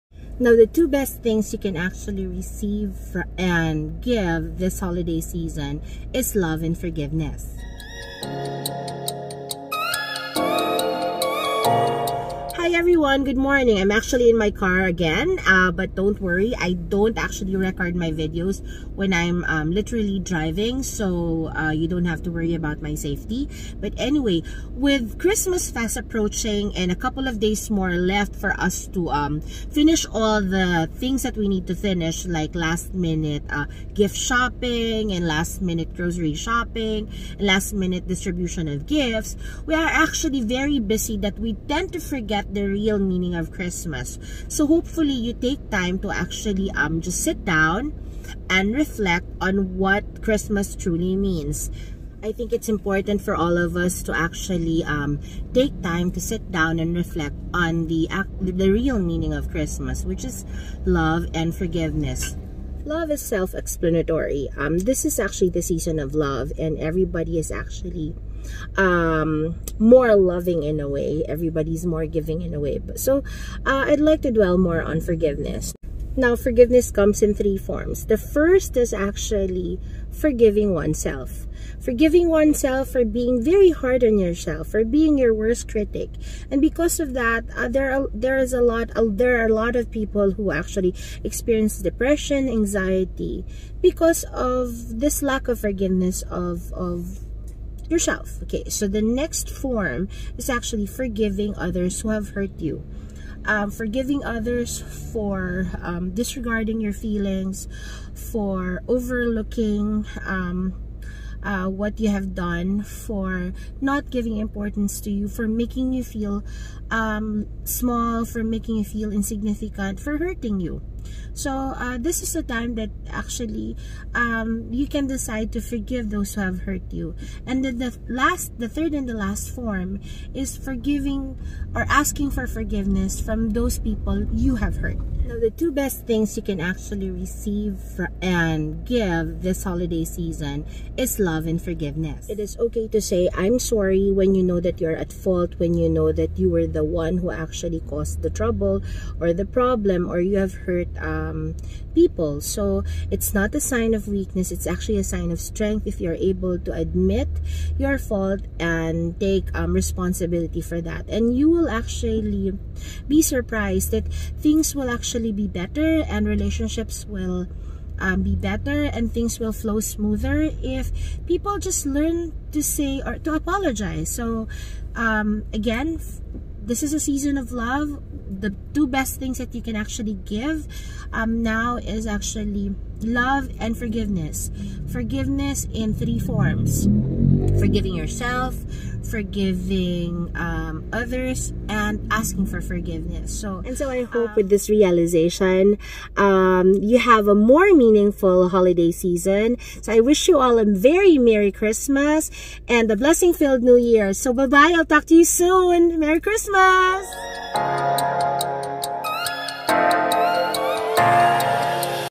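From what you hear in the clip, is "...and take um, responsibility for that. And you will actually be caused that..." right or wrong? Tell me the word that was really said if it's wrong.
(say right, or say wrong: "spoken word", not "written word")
wrong: "surprised", not "caused".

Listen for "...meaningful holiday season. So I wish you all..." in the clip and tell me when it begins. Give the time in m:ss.
3:17.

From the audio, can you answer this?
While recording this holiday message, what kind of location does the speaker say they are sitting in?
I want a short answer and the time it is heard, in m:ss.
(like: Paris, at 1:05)
car, at 0:14.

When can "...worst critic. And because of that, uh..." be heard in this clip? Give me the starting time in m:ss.
1:25.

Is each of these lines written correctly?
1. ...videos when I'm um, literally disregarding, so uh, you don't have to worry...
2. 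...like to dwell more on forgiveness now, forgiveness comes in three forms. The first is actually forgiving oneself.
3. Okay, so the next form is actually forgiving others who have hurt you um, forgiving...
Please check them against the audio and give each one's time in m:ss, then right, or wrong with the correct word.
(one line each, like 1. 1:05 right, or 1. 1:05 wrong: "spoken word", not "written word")
1. 0:18 wrong: "driving", not "disregarding"
2. 1:13 right
3. 1:38 right.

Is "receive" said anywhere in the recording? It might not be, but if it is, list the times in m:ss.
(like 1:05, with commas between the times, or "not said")
0:02, 2:17.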